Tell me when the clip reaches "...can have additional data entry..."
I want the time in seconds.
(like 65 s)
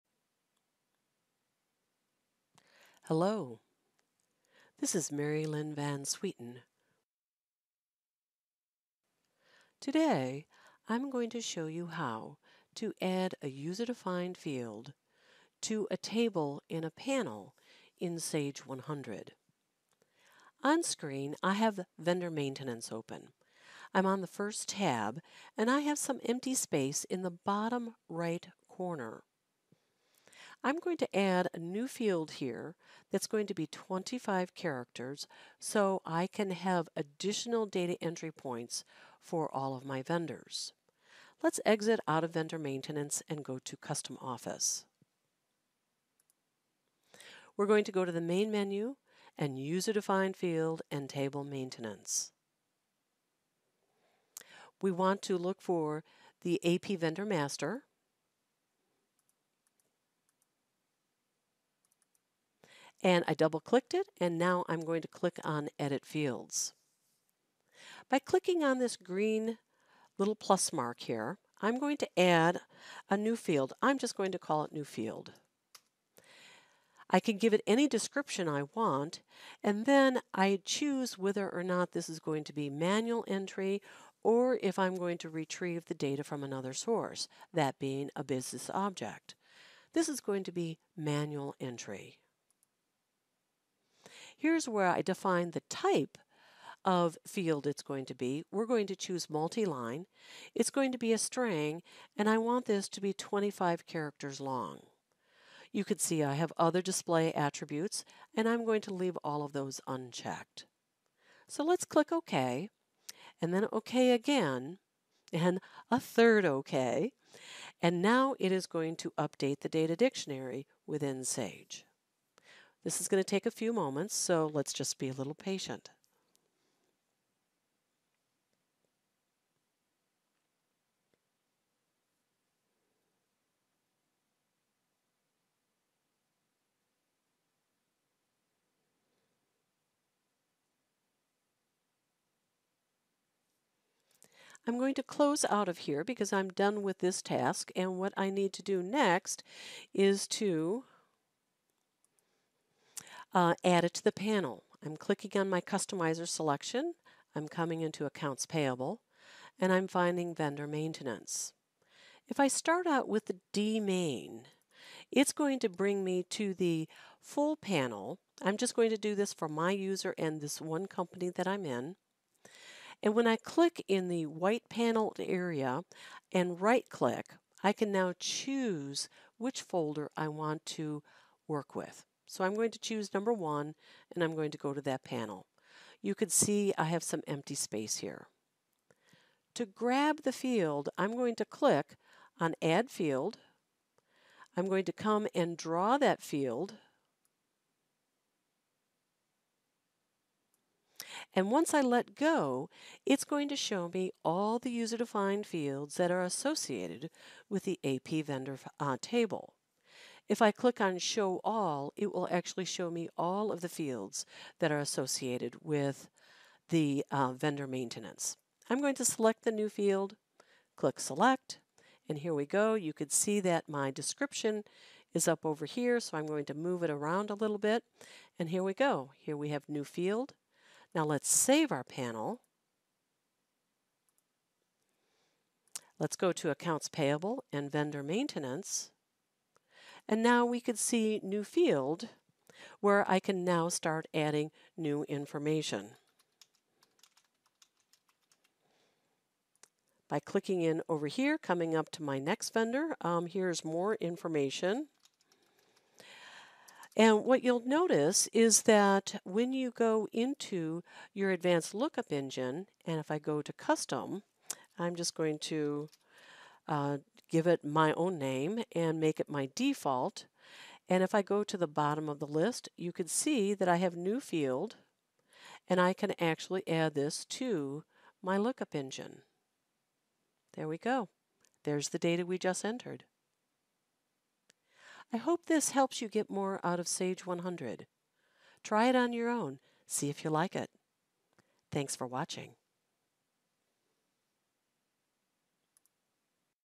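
36 s.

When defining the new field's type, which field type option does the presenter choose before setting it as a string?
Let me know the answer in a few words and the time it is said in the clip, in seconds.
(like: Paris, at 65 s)
Multi-line, at 99 s.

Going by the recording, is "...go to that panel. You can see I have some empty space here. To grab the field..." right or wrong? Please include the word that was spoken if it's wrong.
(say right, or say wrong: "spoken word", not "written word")
right.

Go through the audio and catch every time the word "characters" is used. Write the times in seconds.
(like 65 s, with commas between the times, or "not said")
34 s, 103 s.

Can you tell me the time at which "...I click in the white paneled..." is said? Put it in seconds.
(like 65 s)
173 s.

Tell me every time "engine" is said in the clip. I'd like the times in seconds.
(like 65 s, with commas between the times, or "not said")
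262 s, 278 s.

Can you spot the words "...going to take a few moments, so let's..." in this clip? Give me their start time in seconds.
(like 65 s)
123 s.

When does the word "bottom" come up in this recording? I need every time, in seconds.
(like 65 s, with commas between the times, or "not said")
27 s, 271 s.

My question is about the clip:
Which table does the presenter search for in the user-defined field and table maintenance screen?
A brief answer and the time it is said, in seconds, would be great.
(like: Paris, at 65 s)
AP vendor master, at 56 s.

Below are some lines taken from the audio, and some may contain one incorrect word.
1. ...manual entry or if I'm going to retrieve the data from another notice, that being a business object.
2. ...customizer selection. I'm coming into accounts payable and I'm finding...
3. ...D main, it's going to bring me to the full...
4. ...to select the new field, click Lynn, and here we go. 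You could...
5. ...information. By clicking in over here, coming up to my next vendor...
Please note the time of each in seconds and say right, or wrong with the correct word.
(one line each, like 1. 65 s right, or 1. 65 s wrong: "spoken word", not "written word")
1. 82 s wrong: "source", not "notice"
2. 155 s right
3. 163 s right
4. 218 s wrong: "Select", not "Lynn"
5. 245 s right.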